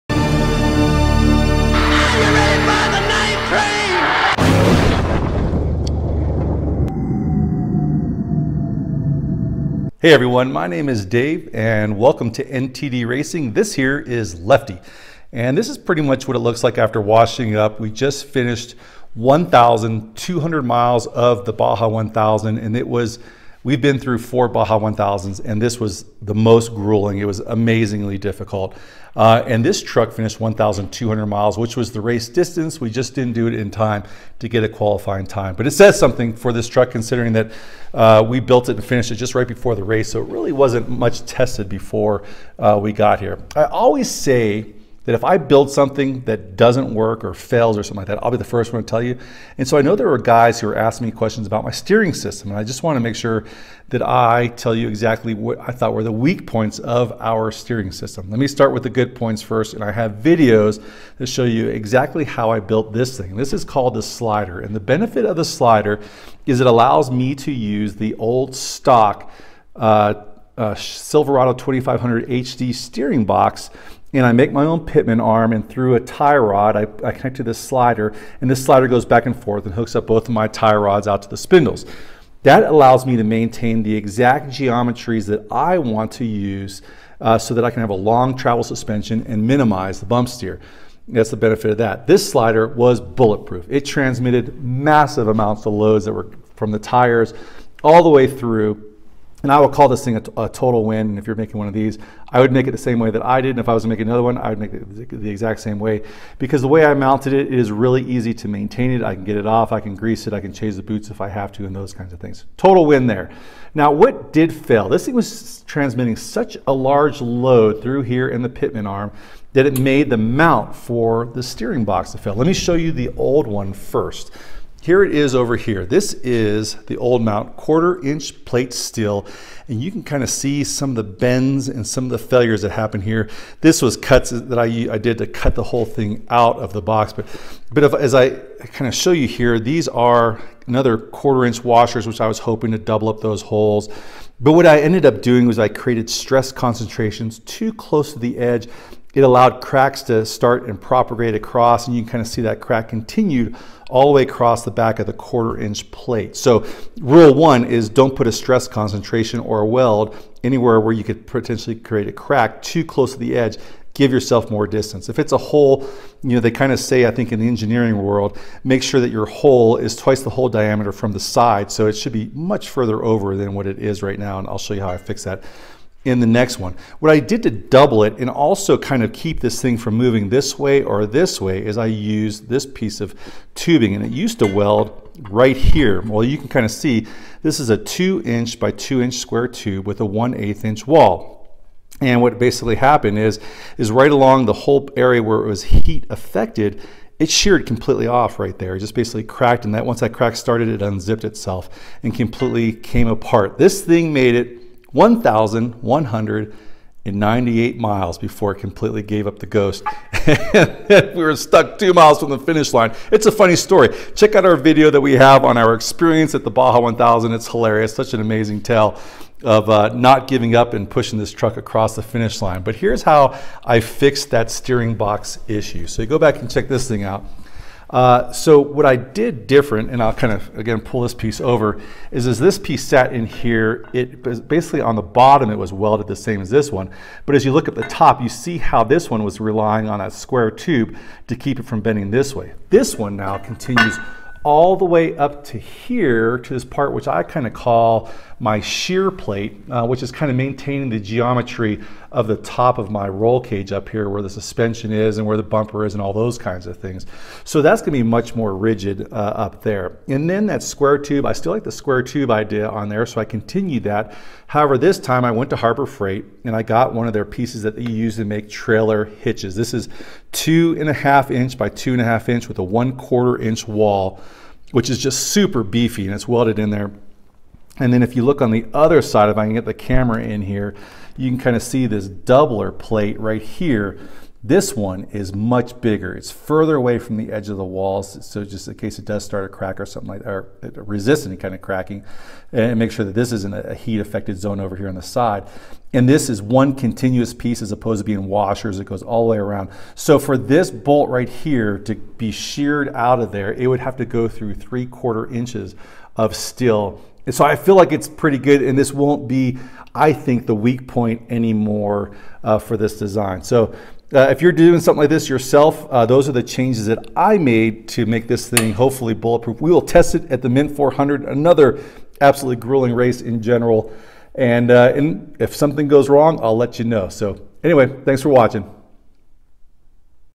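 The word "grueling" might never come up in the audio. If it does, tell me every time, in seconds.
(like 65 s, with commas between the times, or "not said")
26 s, 322 s.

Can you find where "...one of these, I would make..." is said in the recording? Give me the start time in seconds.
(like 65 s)
101 s.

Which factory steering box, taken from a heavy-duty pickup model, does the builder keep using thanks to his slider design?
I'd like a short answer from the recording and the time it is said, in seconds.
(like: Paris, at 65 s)
Silverado 2500 HD, at 70 s.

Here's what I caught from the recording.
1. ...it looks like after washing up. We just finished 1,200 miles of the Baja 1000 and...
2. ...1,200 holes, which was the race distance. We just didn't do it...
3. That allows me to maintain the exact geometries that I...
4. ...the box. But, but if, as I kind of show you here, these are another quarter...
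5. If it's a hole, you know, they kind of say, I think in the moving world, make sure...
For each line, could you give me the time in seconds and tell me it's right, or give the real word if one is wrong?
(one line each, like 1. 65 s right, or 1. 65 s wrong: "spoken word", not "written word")
1. 16 s right
2. 30 s wrong: "miles", not "holes"
3. 82 s right
4. 136 s right
5. 165 s wrong: "engineering", not "moving".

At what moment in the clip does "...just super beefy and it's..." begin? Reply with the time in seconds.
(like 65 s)
274 s.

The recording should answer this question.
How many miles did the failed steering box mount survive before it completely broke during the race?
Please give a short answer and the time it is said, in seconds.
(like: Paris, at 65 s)
1,198, at 204 s.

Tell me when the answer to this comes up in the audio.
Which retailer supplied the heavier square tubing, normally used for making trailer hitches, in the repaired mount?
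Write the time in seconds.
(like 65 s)
265 s.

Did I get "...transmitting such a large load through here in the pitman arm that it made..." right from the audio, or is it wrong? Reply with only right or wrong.
right.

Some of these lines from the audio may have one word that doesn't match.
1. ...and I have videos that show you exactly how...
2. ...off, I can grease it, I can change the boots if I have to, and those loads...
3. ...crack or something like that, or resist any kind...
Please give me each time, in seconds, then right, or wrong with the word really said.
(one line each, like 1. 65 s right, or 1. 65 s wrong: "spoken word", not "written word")
1. 59 s right
2. 109 s wrong: "kinds", not "loads"
3. 289 s right.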